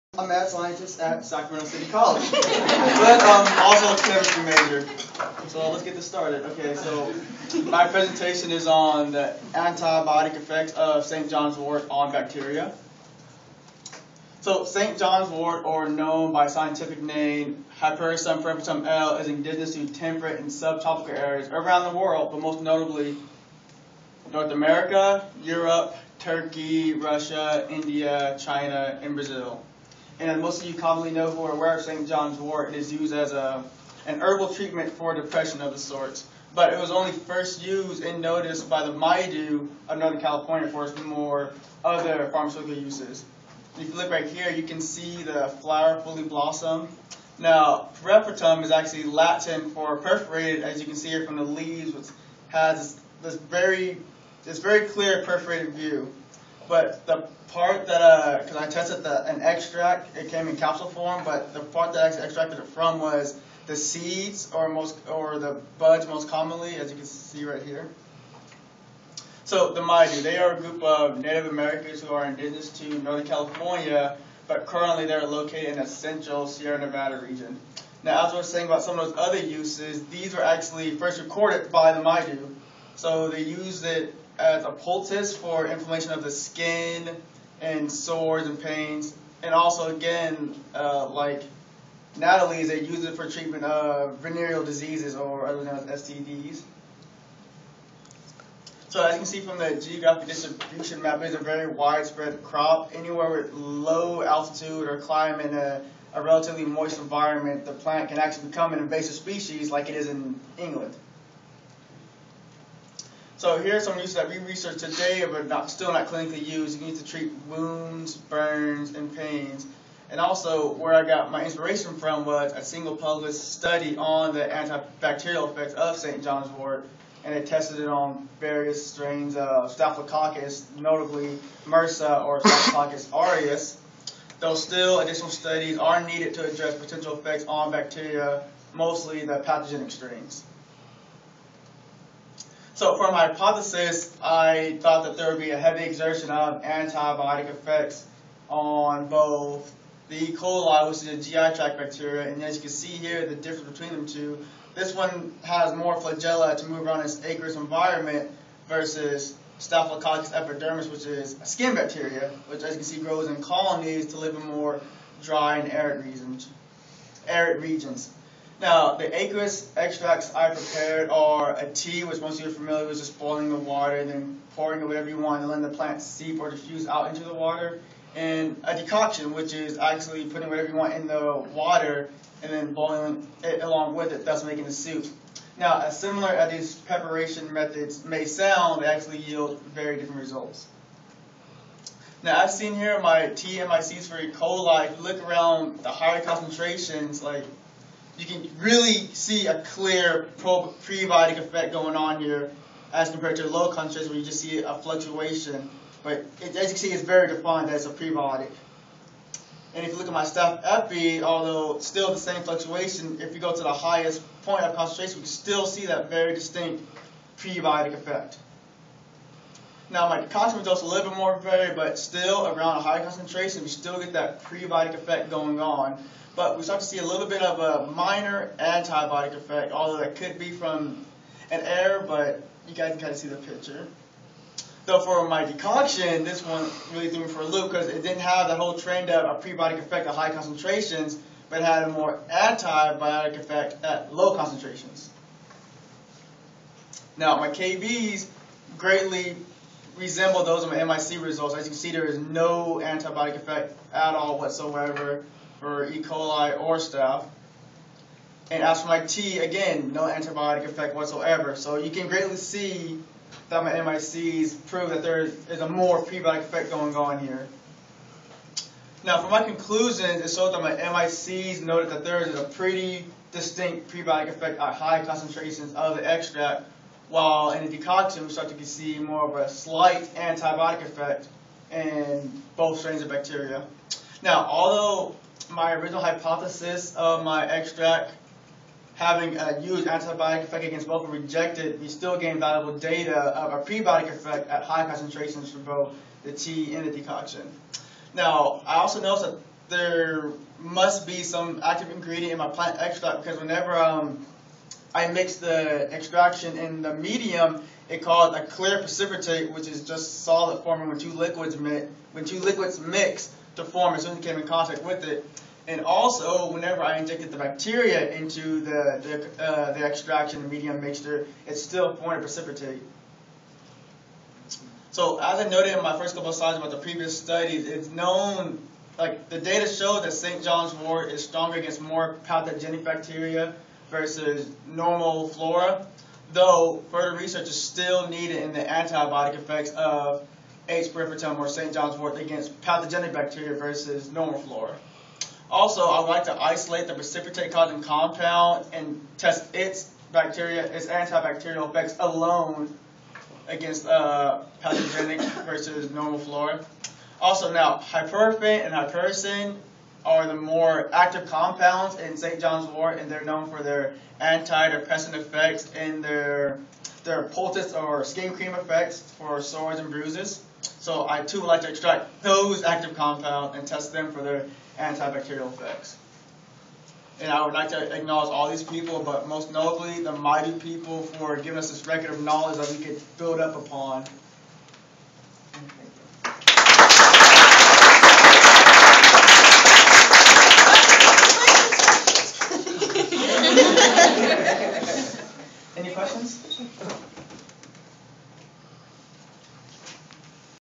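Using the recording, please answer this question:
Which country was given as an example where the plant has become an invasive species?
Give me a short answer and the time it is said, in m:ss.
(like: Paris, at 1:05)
England, at 1:50.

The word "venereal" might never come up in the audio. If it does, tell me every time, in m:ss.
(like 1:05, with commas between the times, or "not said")
1:34.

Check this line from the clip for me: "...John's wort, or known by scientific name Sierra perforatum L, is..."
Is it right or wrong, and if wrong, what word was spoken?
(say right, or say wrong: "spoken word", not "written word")
wrong: "Hypericum", not "Sierra".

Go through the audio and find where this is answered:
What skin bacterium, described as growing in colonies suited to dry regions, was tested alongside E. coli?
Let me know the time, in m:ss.
2:39.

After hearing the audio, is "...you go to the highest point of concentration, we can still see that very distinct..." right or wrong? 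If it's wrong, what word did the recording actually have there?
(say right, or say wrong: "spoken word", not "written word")
right.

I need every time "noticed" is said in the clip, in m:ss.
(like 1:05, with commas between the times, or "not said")
0:38, 4:59.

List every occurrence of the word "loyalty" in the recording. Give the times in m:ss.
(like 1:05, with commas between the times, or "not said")
not said.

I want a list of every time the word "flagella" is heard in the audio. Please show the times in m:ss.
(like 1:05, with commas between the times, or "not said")
2:35.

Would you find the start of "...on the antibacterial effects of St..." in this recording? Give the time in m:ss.
2:03.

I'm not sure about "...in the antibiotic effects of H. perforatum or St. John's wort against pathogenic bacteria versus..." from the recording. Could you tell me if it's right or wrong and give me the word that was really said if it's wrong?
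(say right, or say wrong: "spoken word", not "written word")
right.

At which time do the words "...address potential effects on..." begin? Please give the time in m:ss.
2:16.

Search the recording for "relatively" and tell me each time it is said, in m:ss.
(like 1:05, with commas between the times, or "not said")
1:46.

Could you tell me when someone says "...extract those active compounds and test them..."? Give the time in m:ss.
6:11.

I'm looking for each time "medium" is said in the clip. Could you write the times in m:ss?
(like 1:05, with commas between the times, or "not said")
5:06, 5:20.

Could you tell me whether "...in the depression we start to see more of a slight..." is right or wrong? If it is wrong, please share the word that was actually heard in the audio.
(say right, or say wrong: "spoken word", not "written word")
wrong: "decoction", not "depression".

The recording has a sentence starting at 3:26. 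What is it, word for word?
But it, as you see, it's very defined as a prebiotic.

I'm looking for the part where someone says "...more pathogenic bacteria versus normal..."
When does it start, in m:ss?
5:31.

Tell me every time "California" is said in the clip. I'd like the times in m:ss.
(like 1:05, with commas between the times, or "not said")
0:40, 1:13.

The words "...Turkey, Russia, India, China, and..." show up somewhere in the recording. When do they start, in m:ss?
0:26.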